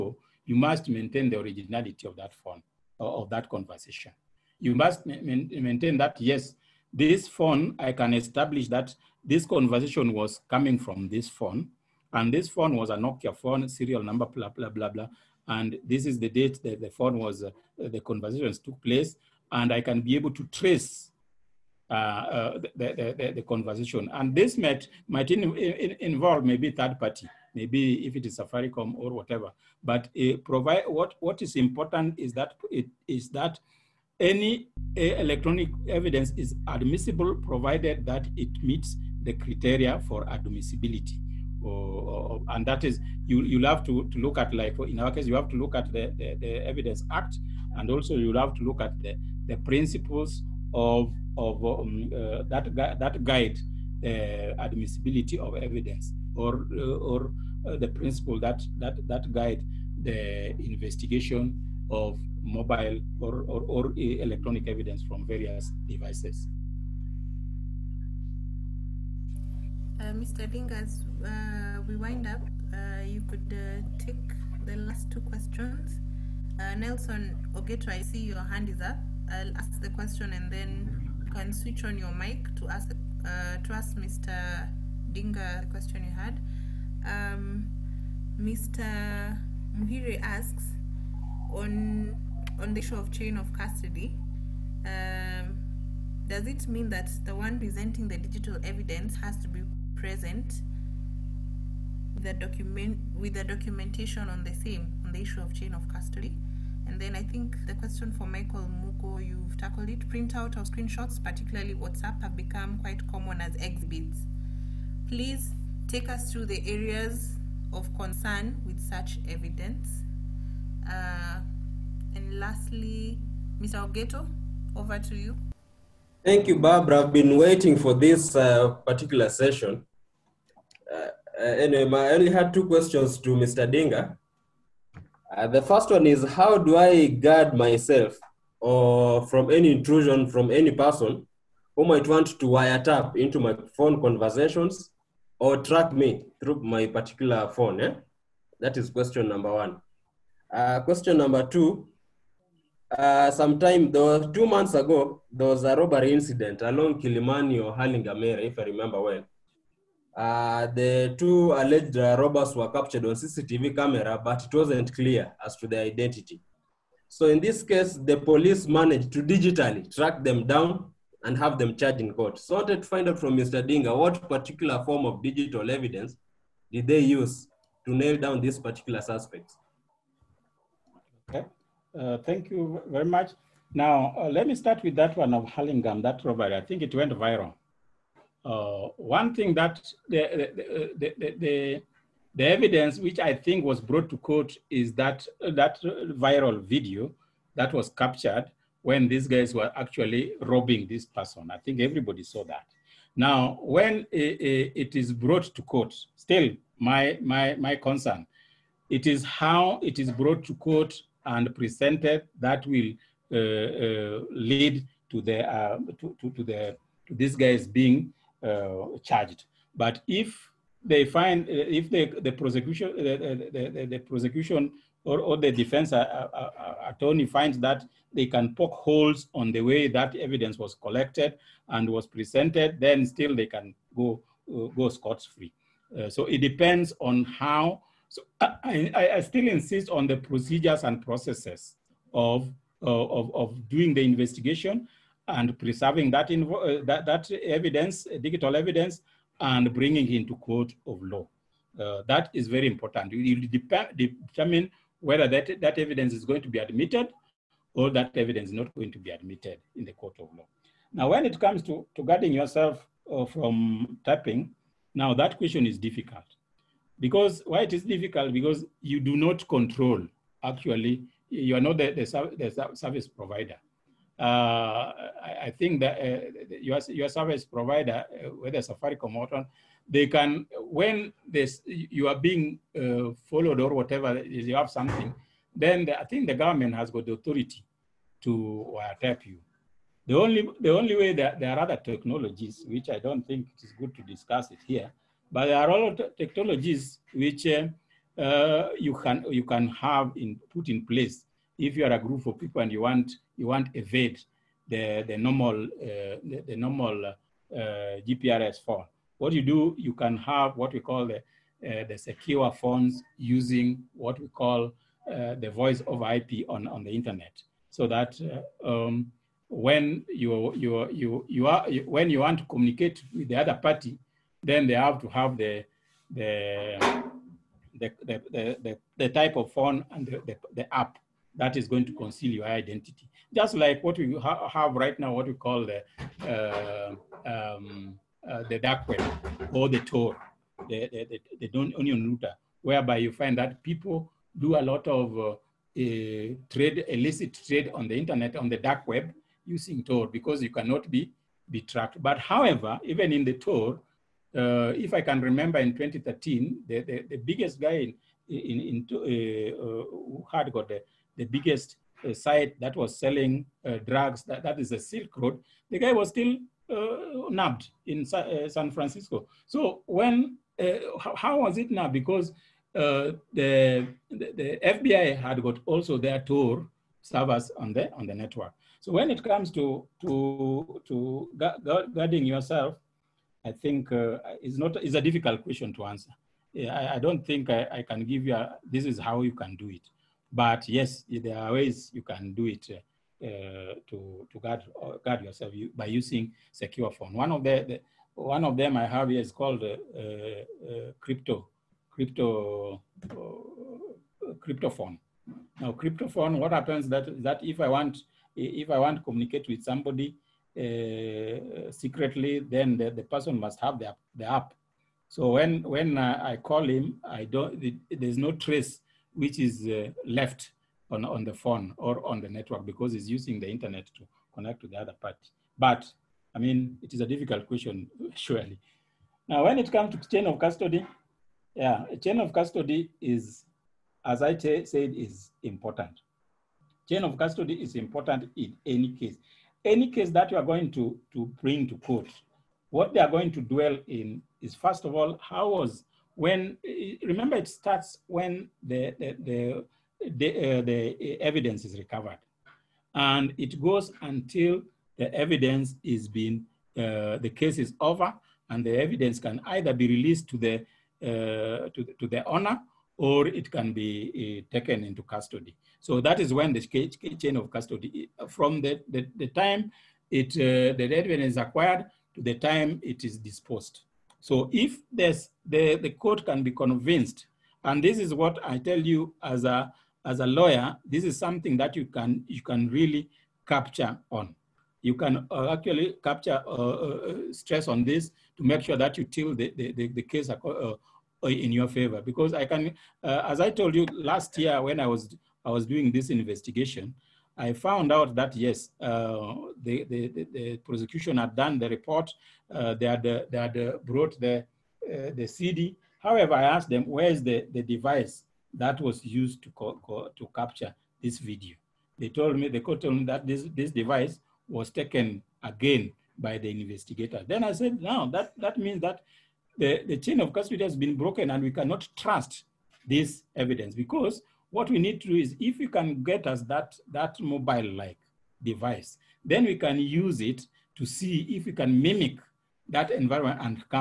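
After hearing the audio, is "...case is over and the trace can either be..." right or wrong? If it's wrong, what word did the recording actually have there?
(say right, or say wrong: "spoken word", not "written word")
wrong: "evidence", not "trace".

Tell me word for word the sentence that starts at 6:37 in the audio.
One of, the, the one of them I have here is called uh, crypto, crypto, crypto phone.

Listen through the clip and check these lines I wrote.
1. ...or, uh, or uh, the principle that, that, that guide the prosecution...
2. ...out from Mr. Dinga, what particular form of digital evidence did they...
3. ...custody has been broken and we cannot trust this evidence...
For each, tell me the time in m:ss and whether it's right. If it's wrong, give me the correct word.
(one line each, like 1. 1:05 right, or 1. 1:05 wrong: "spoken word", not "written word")
1. 0:56 wrong: "investigation", not "prosecution"
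2. 2:53 right
3. 8:40 right.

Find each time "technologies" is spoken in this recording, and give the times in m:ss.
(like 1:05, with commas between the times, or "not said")
4:51, 4:56.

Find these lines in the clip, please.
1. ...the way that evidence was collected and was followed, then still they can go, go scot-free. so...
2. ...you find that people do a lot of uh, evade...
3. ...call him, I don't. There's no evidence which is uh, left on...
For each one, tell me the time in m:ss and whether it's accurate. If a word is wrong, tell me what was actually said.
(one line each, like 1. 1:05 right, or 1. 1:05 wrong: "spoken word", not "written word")
1. 3:49 wrong: "presented", not "followed"
2. 5:42 wrong: "trade", not "evade"
3. 6:56 wrong: "trace", not "evidence".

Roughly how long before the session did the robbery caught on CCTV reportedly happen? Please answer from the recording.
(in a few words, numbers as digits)
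two months ago.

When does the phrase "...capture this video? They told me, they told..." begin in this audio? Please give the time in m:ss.
8:30.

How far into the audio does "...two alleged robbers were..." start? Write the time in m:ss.
2:41.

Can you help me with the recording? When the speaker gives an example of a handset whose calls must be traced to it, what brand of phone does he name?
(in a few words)
Nokia.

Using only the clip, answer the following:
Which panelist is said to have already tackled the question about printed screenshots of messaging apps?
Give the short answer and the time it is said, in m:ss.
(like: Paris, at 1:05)
Michael Muko, at 1:48.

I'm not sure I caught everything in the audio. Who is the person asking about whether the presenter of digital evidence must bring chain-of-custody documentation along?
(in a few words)
Mr. Muhire.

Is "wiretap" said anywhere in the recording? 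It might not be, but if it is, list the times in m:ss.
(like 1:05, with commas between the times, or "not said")
2:22, 4:48.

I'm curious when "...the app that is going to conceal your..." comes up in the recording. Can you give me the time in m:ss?
5:30.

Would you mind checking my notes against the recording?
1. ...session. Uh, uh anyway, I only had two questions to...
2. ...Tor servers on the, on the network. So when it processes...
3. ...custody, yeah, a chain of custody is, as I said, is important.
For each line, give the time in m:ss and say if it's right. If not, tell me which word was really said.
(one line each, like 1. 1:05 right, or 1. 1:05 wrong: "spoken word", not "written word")
1. 2:09 right
2. 6:16 wrong: "comes", not "processes"
3. 7:10 right.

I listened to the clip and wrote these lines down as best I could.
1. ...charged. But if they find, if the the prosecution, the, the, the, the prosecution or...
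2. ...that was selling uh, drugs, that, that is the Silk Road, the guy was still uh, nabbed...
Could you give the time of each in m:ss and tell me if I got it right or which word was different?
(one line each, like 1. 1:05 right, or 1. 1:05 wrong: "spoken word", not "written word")
1. 3:39 right
2. 6:02 right.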